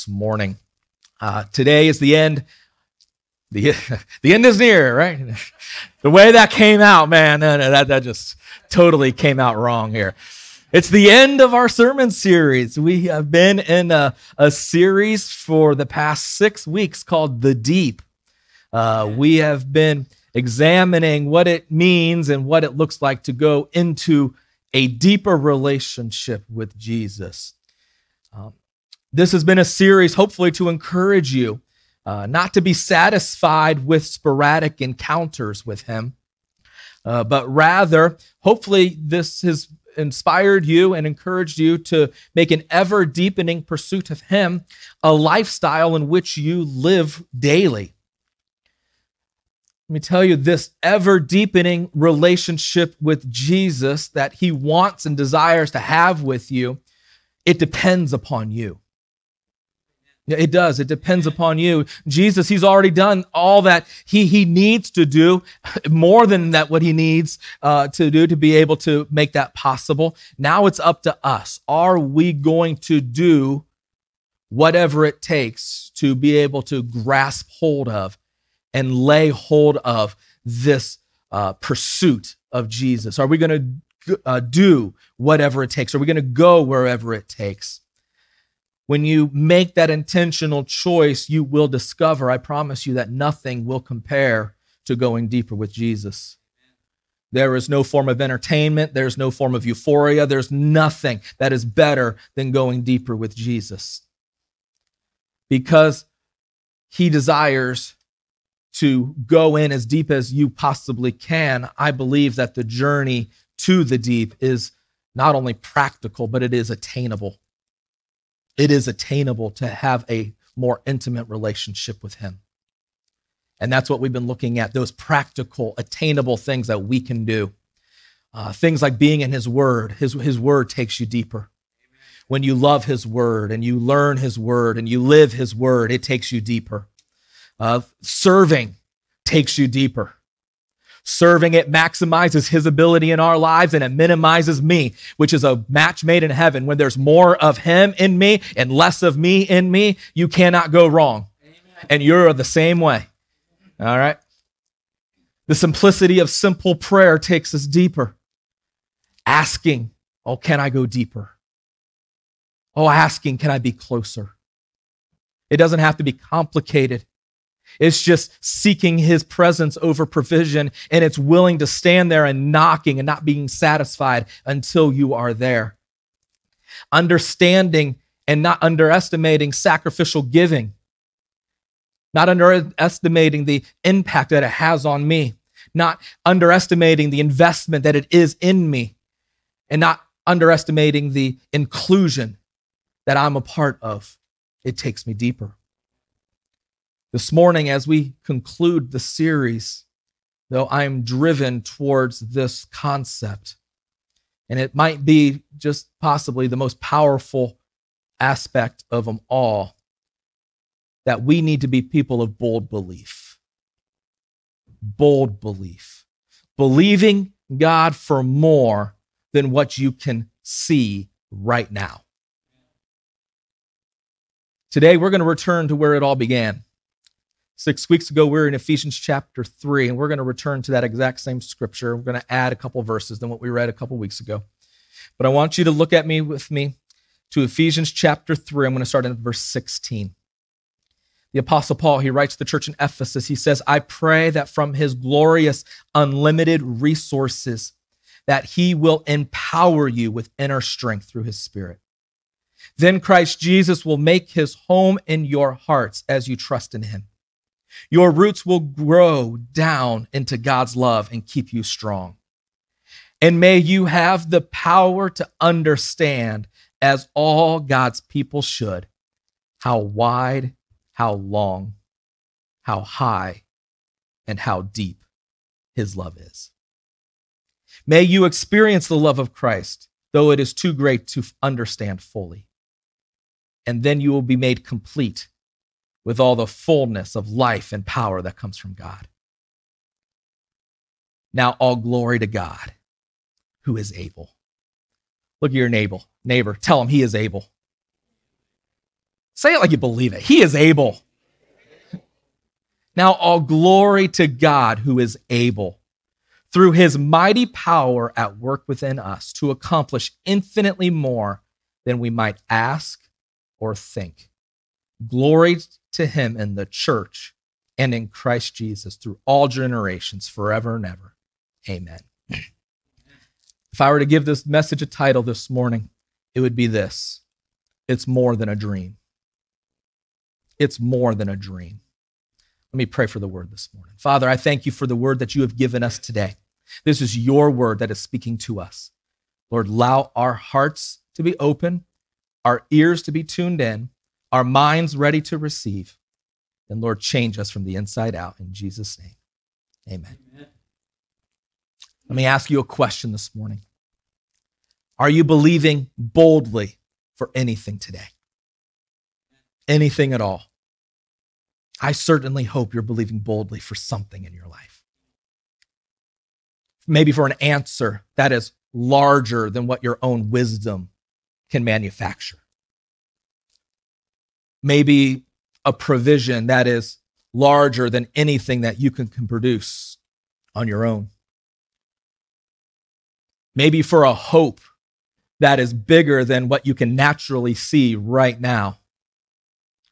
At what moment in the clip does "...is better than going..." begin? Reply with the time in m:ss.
1:41.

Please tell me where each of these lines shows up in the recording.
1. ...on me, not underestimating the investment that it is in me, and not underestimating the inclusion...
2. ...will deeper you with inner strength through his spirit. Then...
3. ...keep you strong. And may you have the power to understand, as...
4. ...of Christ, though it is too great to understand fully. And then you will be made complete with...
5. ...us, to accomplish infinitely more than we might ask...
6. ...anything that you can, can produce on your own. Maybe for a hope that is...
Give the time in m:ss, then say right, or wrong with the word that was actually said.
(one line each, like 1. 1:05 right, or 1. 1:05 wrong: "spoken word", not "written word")
1. 3:04 right
2. 4:08 wrong: "empower", not "deeper"
3. 4:21 right
4. 4:39 right
5. 5:08 right
6. 6:18 right.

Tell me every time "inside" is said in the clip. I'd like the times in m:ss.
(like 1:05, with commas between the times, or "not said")
5:47.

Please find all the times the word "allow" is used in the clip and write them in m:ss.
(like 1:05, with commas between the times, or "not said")
5:39.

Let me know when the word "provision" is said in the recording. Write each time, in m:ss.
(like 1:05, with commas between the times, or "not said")
2:50, 6:15.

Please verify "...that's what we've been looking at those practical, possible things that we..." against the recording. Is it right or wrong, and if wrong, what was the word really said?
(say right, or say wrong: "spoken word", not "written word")
wrong: "attainable", not "possible".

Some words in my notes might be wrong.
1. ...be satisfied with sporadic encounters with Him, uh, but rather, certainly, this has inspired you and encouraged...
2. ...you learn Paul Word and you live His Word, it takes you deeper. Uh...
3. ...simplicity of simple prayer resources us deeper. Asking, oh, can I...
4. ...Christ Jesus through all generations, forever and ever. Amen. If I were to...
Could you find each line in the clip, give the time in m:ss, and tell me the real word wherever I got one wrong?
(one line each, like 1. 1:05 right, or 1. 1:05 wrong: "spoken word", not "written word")
1. 0:32 wrong: "hopefully", not "certainly"
2. 2:13 wrong: "His", not "Paul"
3. 2:35 wrong: "takes", not "resources"
4. 5:18 right.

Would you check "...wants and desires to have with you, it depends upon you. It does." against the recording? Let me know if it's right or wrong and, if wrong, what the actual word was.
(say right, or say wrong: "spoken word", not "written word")
right.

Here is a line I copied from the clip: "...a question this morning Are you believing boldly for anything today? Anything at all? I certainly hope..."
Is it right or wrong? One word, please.
right.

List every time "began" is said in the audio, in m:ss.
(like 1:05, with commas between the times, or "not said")
3:46.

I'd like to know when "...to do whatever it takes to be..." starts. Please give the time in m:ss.
1:12.